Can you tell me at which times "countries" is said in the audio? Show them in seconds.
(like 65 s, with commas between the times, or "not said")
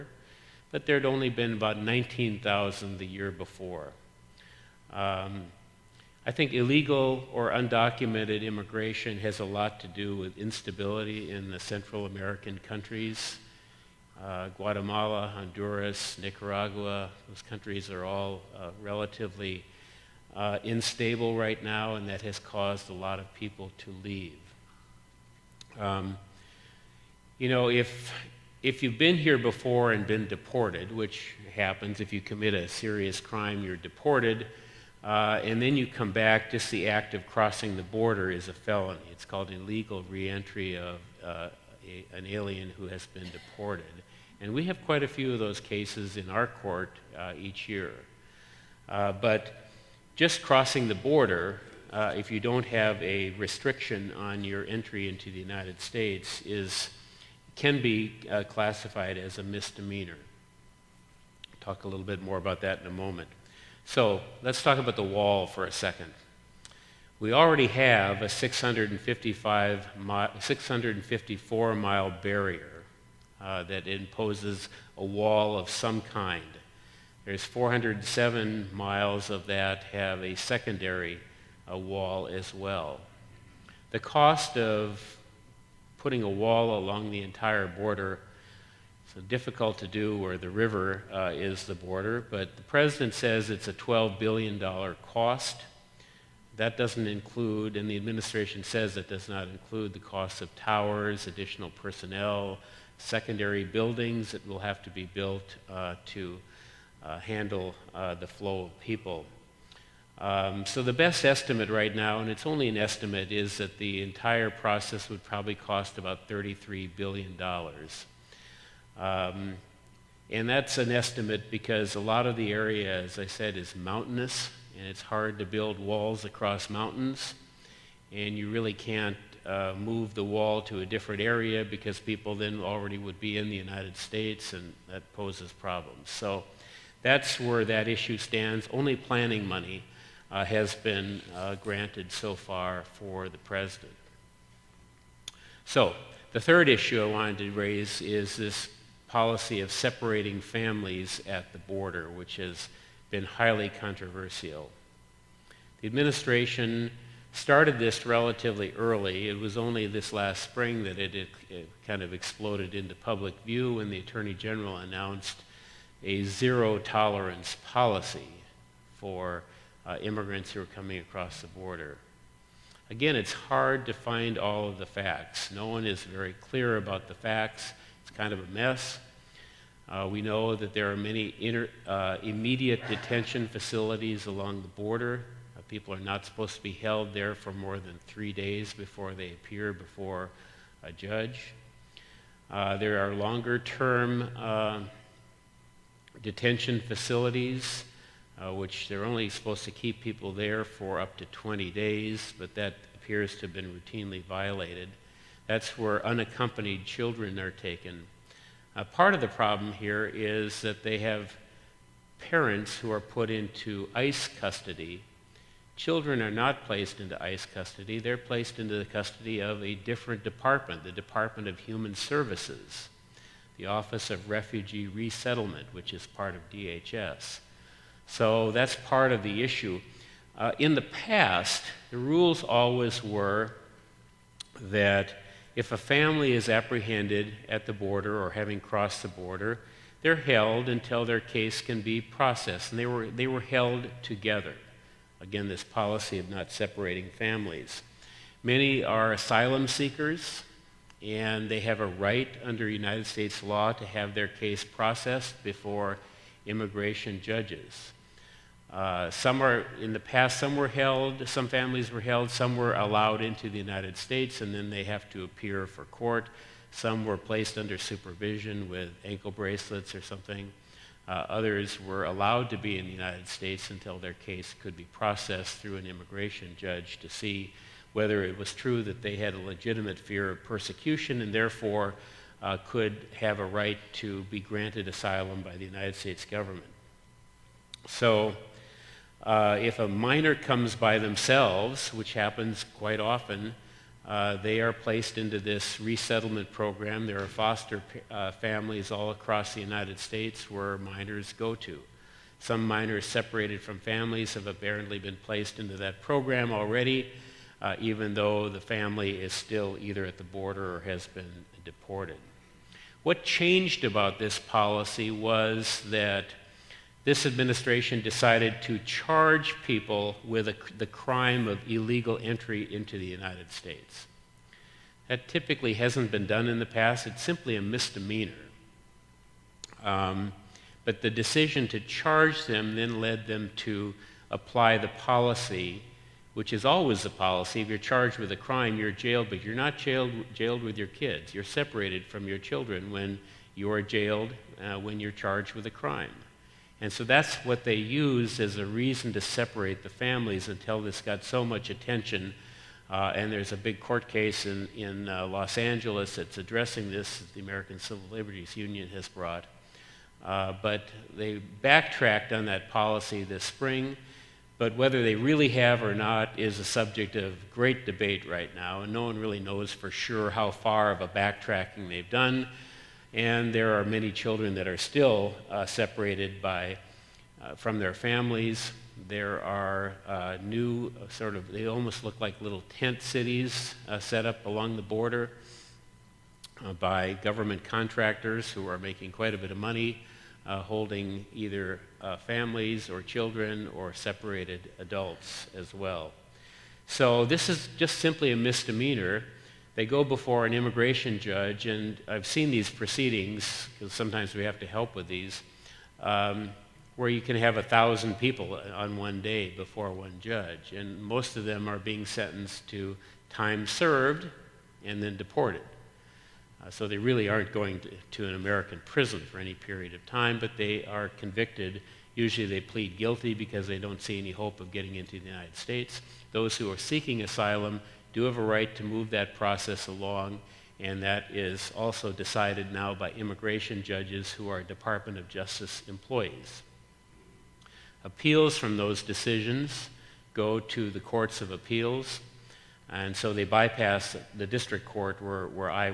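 12 s, 17 s.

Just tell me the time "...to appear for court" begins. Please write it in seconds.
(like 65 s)
265 s.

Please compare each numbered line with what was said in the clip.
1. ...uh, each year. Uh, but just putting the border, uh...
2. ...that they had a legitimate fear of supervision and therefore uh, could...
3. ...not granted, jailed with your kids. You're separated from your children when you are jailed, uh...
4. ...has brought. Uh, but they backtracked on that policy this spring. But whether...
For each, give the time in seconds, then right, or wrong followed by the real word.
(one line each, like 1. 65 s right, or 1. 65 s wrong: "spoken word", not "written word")
1. 47 s wrong: "crossing", not "putting"
2. 278 s wrong: "persecution", not "supervision"
3. 339 s wrong: "jailed", not "granted"
4. 358 s right.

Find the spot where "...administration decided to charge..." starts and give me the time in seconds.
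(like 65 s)
317 s.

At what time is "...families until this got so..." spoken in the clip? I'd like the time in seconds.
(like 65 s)
349 s.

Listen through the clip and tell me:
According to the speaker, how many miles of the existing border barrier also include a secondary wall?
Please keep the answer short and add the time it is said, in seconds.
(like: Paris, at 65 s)
407, at 77 s.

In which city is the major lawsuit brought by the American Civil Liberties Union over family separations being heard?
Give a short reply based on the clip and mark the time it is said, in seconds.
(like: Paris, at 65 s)
Los Angeles, at 355 s.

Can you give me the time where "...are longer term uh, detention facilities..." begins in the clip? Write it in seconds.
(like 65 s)
193 s.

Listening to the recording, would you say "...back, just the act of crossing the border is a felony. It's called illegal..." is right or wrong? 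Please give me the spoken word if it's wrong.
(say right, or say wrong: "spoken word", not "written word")
right.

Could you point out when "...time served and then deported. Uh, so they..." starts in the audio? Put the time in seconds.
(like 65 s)
413 s.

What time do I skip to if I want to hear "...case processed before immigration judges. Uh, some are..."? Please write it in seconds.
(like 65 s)
254 s.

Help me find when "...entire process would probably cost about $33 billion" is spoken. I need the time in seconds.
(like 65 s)
114 s.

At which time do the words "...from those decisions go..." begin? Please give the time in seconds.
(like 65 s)
438 s.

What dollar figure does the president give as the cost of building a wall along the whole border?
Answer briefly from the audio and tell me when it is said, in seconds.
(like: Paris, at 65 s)
$12 billion, at 93 s.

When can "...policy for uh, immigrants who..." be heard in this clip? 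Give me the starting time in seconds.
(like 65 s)
167 s.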